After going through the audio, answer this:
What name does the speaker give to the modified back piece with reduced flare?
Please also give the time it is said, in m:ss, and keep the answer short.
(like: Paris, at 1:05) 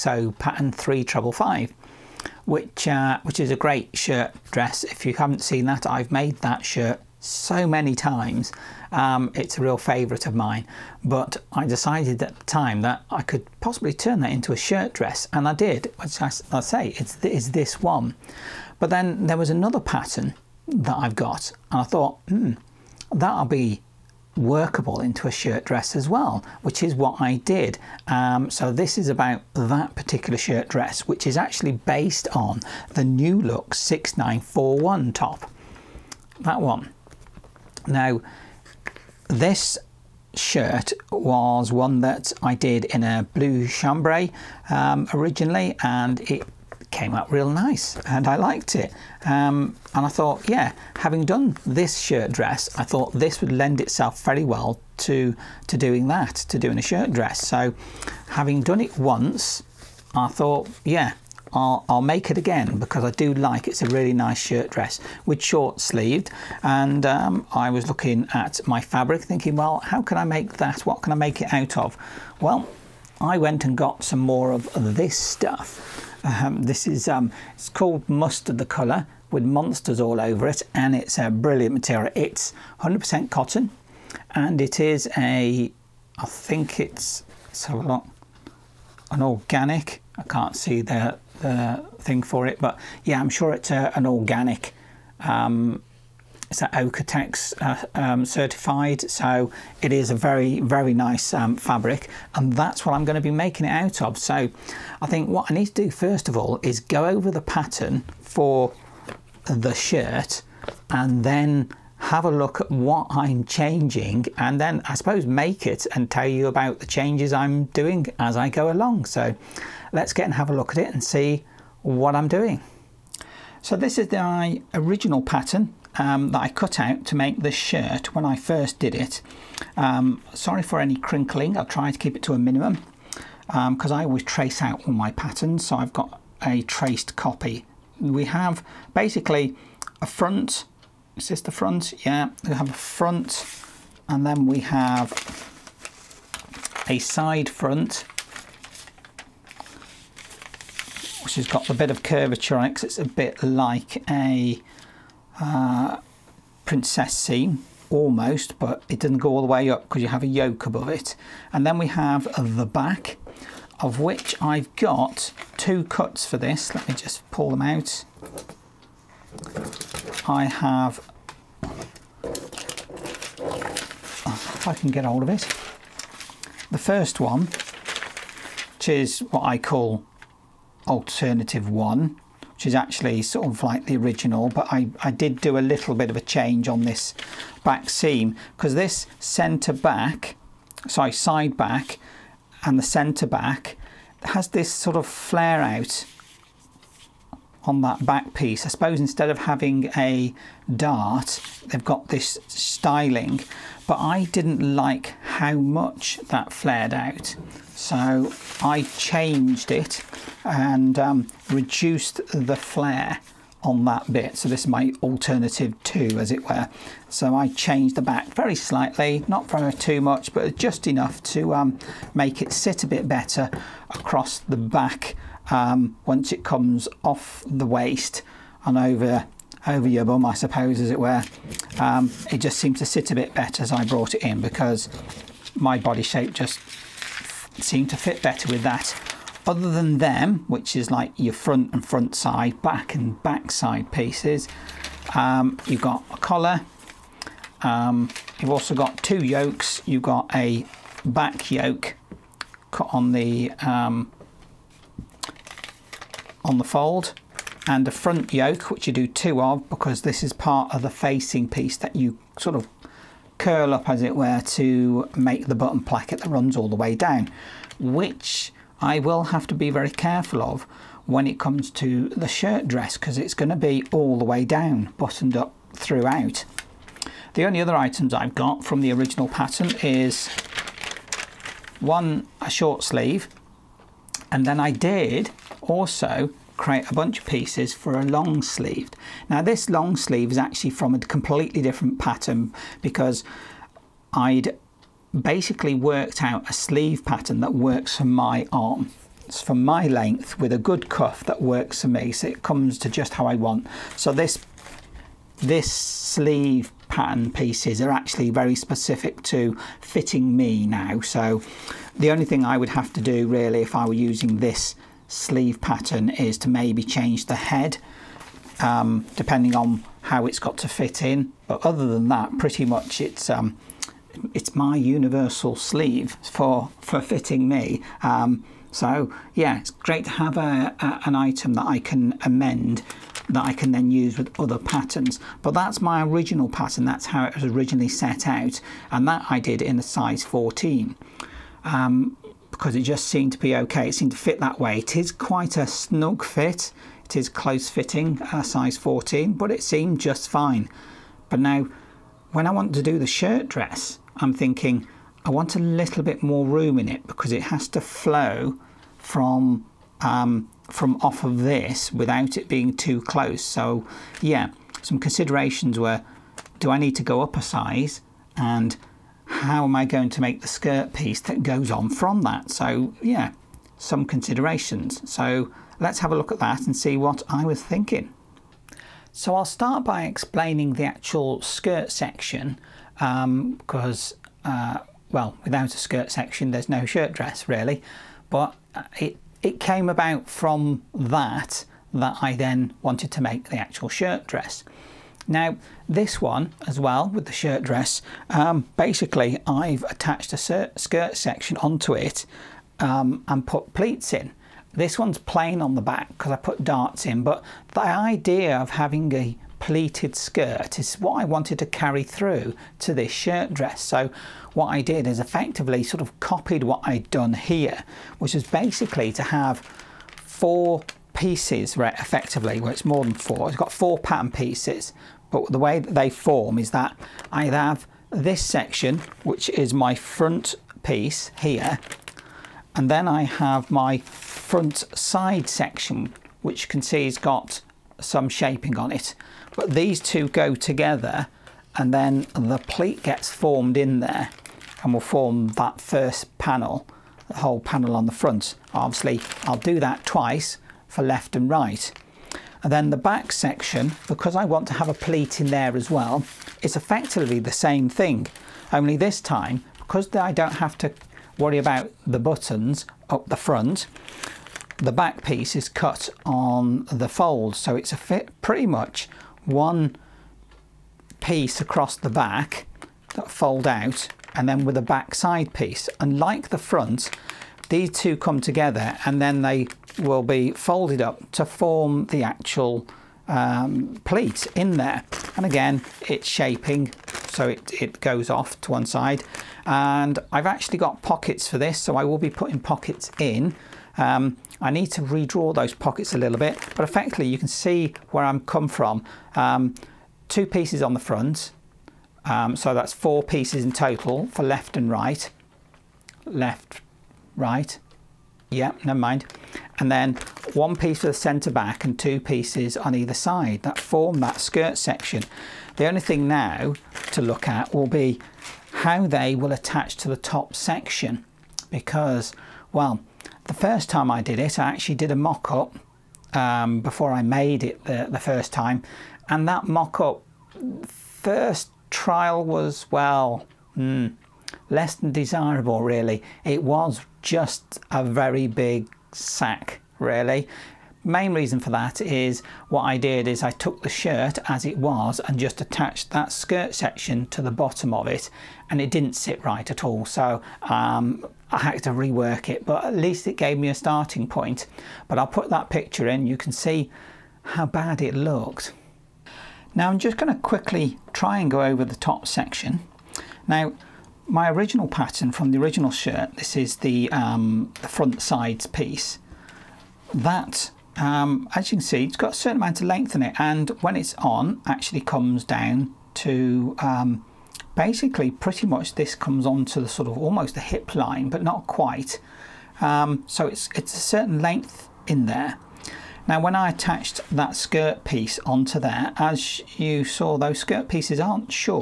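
alternative two, at 3:35.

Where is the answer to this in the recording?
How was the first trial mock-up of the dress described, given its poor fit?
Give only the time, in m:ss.
8:57.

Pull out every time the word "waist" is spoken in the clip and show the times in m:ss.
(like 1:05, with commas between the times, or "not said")
3:47.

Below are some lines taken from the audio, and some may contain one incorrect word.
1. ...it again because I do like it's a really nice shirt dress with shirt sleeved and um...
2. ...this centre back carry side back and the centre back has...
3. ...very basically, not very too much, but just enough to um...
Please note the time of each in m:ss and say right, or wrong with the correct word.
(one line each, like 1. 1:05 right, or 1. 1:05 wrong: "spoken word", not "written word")
1. 1:02 wrong: "short", not "shirt"
2. 3:08 wrong: "sorry", not "carry"
3. 3:38 wrong: "slightly", not "basically".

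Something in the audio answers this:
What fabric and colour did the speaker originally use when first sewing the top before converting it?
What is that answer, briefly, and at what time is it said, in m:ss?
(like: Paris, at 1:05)
blue chambray, at 0:43.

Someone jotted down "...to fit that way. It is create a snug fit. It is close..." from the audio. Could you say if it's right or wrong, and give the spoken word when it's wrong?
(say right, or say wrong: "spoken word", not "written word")
wrong: "quite", not "create".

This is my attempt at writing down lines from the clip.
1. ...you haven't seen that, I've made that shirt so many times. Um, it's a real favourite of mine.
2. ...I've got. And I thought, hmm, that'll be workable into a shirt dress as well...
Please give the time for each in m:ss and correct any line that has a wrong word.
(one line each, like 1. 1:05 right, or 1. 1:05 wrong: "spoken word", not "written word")
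1. 0:05 right
2. 0:20 right.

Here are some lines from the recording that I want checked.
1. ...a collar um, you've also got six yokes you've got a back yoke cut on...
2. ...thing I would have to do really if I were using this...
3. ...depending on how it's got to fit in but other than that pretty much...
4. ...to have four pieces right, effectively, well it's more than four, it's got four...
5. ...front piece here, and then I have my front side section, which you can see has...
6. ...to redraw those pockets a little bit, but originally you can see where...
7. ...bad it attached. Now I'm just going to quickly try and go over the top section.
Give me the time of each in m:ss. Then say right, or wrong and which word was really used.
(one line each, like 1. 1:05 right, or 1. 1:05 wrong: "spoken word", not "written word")
1. 4:06 wrong: "two", not "six"
2. 5:12 right
3. 5:19 right
4. 6:59 right
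5. 7:09 right
6. 8:14 wrong: "effectively", not "originally"
7. 9:17 wrong: "looked", not "attached".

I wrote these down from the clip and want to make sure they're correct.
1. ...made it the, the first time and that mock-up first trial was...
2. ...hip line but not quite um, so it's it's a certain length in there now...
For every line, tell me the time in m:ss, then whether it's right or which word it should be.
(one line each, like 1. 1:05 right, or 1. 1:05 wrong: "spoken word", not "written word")
1. 8:47 right
2. 9:40 right.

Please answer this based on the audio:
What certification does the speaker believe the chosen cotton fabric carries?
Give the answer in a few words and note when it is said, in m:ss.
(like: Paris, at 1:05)
Oeko-Tex, at 1:36.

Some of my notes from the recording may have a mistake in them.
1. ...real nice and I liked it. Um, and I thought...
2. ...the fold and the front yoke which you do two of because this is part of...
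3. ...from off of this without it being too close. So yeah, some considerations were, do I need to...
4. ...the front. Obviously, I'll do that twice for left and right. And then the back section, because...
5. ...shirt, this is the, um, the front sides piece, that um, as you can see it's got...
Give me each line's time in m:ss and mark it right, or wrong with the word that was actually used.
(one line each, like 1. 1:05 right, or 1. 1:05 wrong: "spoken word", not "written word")
1. 0:47 right
2. 4:16 right
3. 6:00 right
4. 7:28 right
5. 9:25 right.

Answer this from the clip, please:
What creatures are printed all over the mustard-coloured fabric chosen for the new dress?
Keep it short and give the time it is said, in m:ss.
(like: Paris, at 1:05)
monsters, at 1:19.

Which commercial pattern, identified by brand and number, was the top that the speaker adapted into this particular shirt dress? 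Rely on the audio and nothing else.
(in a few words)
New Look 6941.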